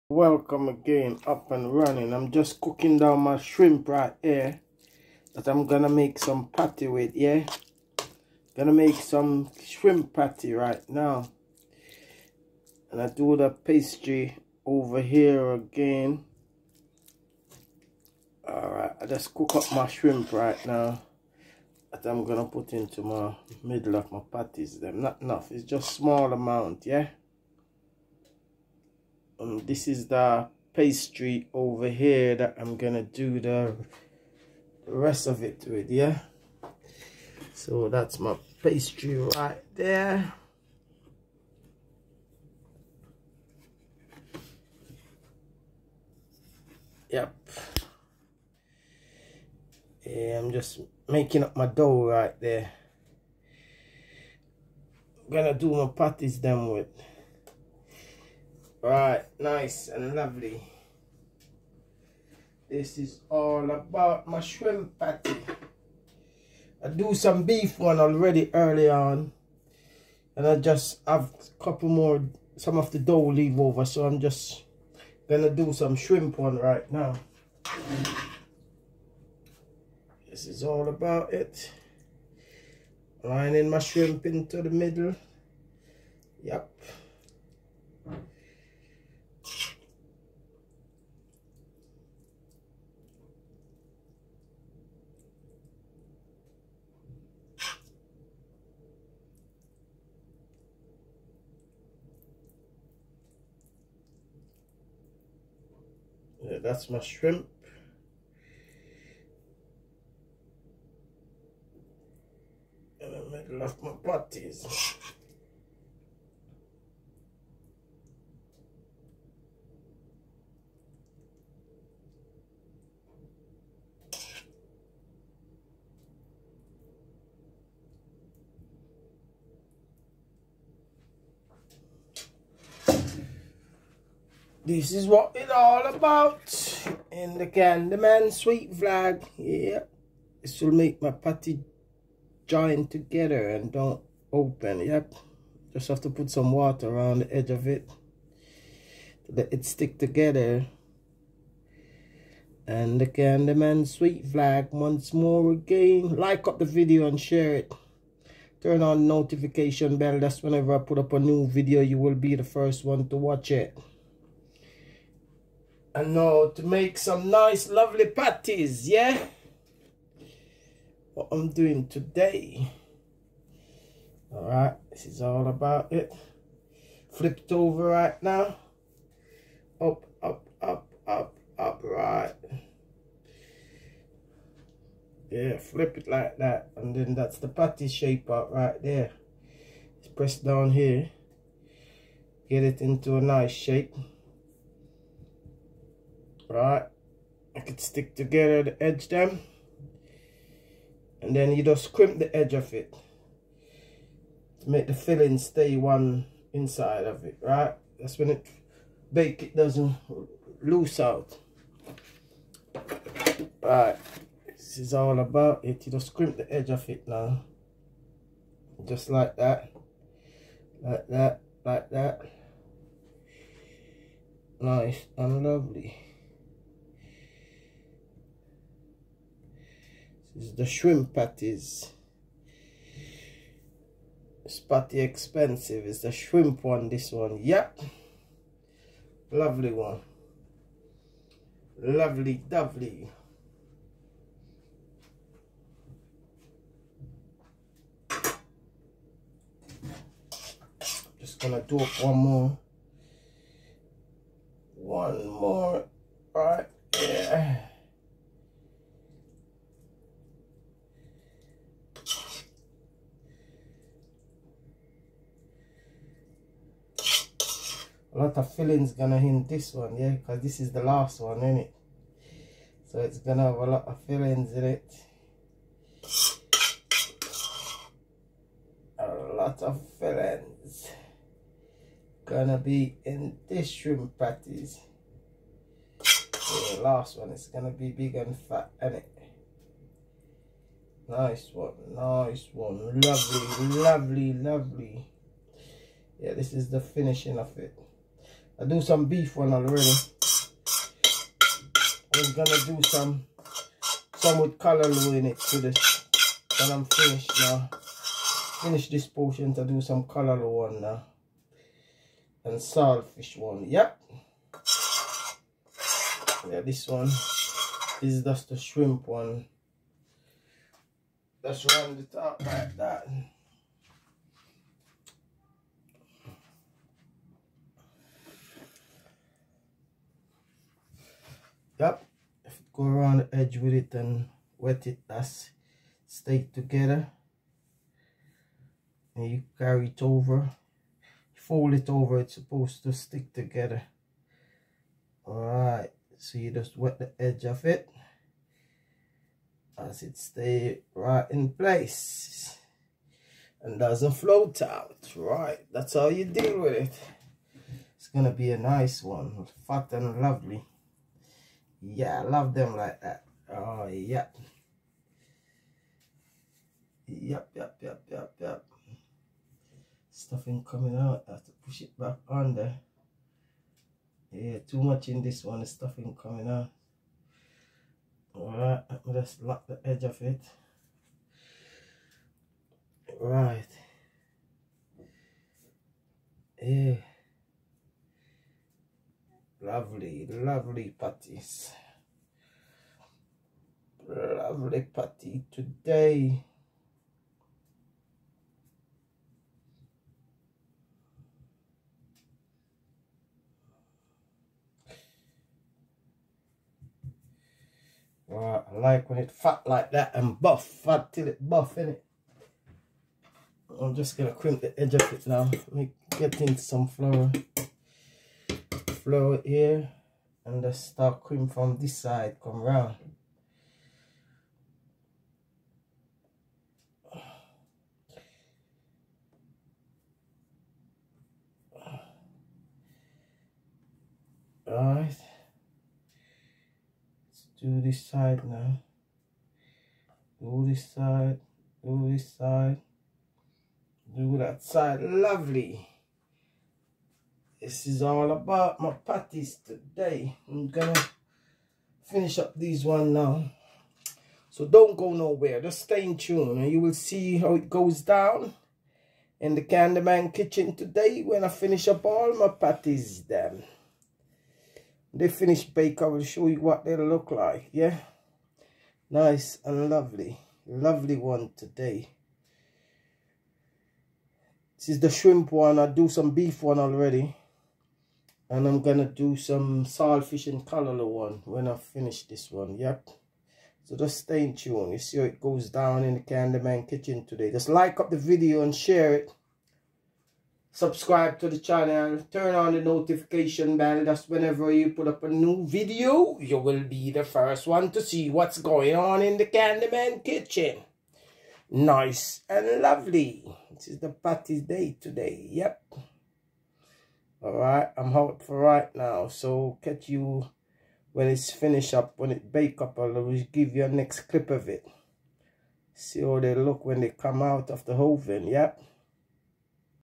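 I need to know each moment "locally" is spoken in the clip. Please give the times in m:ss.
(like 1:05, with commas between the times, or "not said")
not said.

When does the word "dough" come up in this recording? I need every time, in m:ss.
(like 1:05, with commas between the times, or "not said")
0:51, 1:12.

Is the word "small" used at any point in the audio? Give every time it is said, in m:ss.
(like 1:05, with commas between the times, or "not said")
0:25.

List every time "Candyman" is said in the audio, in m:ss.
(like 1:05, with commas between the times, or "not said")
2:17, 2:33, 7:39, 8:06, 8:19.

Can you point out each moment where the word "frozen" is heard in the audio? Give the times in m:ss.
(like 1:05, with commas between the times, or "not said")
not said.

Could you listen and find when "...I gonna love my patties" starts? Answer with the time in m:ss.
1:53.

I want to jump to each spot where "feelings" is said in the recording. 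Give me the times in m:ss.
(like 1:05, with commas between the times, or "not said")
4:28, 4:34, 4:39.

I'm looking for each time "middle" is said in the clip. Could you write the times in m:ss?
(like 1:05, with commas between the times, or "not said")
0:23, 1:24.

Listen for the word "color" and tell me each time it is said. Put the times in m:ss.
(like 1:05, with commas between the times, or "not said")
5:04, 5:10.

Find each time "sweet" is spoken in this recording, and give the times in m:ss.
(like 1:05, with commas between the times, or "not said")
2:18, 2:33.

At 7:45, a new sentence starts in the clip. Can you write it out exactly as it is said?
They finish bake, I will show you what they look like, yeah?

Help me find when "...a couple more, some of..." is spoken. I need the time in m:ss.
1:11.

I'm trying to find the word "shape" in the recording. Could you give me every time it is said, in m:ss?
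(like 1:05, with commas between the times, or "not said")
3:07, 3:13.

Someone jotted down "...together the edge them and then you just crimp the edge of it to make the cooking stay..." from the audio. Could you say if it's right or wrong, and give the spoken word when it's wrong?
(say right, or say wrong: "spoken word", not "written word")
wrong: "filling", not "cooking".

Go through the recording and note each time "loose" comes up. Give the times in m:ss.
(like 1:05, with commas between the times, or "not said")
3:30.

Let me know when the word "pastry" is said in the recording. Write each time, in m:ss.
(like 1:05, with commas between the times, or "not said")
0:13, 0:30, 0:38.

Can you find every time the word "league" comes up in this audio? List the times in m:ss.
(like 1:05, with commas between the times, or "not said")
not said.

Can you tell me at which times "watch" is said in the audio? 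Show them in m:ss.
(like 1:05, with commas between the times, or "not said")
2:43.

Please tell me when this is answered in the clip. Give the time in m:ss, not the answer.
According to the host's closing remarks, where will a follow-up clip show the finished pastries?
8:37.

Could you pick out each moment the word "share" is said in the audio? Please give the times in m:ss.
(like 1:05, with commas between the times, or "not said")
2:37, 8:08.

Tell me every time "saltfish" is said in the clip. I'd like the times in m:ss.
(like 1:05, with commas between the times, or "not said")
5:12, 7:59.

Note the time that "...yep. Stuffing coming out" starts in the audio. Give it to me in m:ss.
6:08.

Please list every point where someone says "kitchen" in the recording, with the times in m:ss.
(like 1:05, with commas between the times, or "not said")
7:40, 8:06, 8:20.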